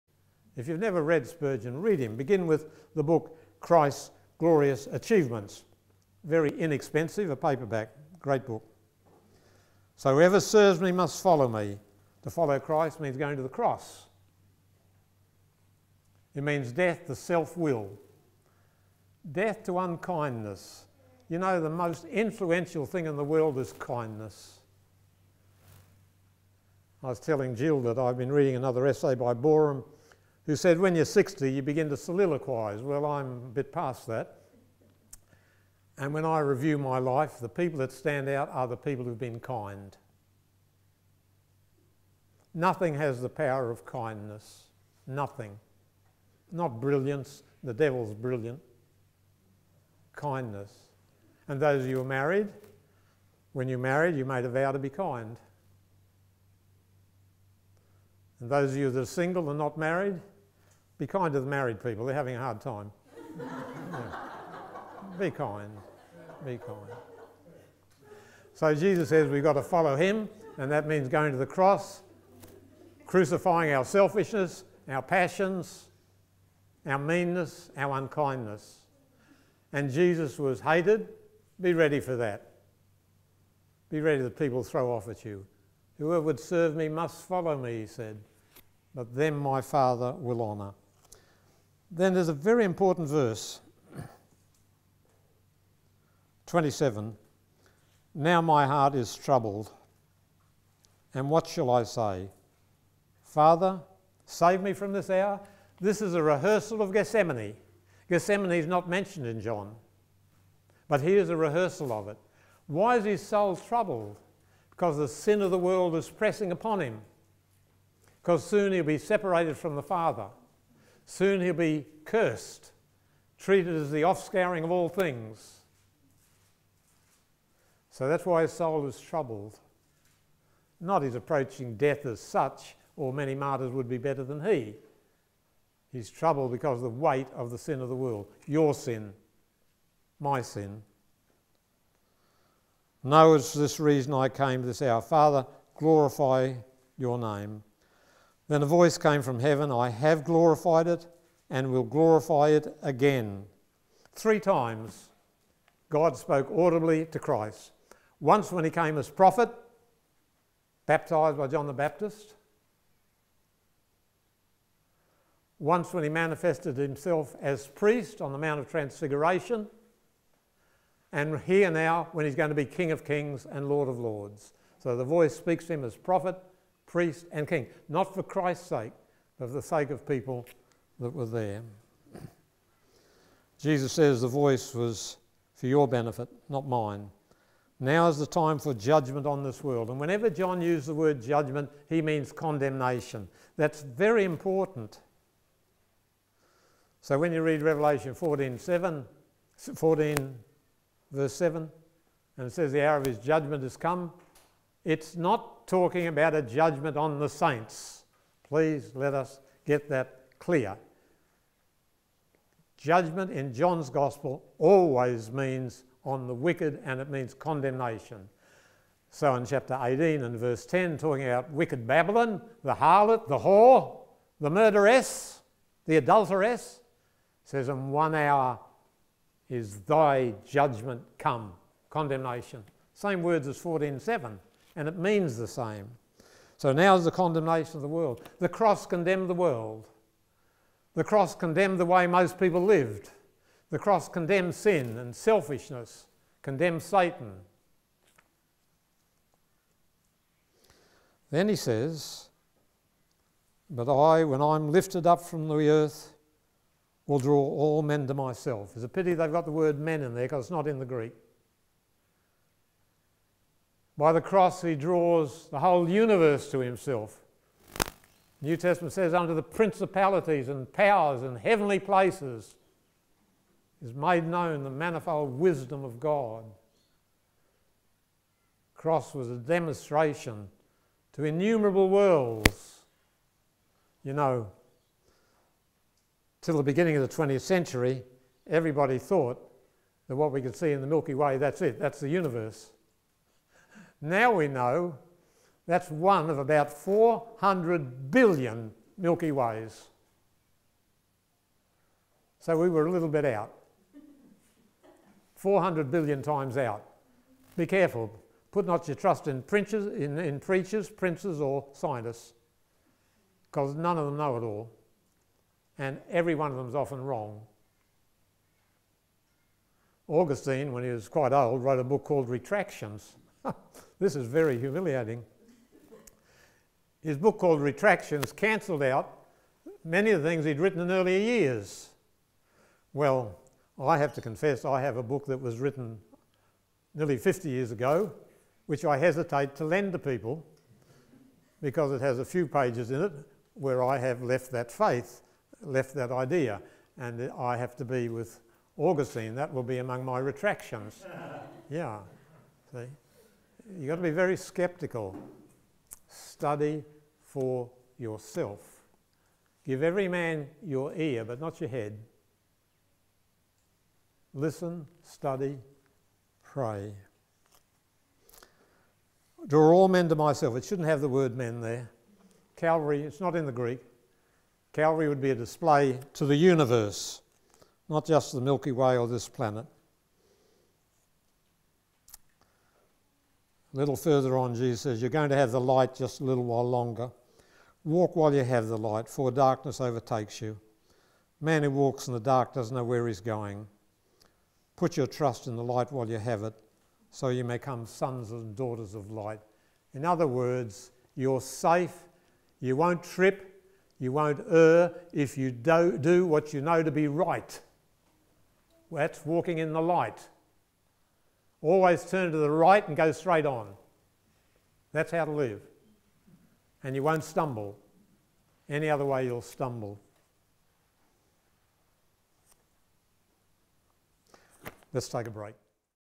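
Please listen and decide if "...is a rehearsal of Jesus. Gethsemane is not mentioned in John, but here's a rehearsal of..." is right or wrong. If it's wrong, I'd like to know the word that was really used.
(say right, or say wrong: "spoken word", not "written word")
wrong: "Gethsemane", not "Jesus".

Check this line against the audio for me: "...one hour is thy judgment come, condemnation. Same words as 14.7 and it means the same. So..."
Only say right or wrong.
right.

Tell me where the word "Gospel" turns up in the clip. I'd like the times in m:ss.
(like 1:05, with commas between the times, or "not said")
3:33.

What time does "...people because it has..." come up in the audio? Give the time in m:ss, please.
5:39.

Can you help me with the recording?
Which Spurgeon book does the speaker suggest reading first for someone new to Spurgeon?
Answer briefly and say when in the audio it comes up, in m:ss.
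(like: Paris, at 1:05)
Christ's Glorious Achievements, at 0:03.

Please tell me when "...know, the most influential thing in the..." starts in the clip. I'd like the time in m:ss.
0:21.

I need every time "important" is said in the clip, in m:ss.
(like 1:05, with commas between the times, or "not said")
1:32, 3:14.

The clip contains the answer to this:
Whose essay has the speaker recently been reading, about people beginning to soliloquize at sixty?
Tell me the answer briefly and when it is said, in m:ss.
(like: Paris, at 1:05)
Boreham, at 0:29.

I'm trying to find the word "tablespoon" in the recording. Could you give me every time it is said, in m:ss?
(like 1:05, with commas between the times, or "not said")
not said.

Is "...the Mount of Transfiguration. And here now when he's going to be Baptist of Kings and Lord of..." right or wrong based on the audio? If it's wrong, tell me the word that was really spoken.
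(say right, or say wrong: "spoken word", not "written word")
wrong: "King", not "Baptist".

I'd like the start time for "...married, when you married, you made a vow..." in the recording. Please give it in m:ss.
0:52.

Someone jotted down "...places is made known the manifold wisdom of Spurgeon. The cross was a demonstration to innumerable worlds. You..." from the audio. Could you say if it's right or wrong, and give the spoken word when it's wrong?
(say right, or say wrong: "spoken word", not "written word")
wrong: "God", not "Spurgeon".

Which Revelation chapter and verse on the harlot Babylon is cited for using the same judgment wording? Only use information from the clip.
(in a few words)
Revelation 18:10.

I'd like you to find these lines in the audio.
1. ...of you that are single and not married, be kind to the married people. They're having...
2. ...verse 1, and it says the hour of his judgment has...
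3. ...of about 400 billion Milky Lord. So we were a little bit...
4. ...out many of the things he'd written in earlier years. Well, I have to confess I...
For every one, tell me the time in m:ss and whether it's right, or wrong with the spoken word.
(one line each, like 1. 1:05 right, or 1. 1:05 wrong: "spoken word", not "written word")
1. 0:58 right
2. 3:21 wrong: "7", not "1"
3. 4:56 wrong: "Ways", not "Lord"
4. 5:28 right.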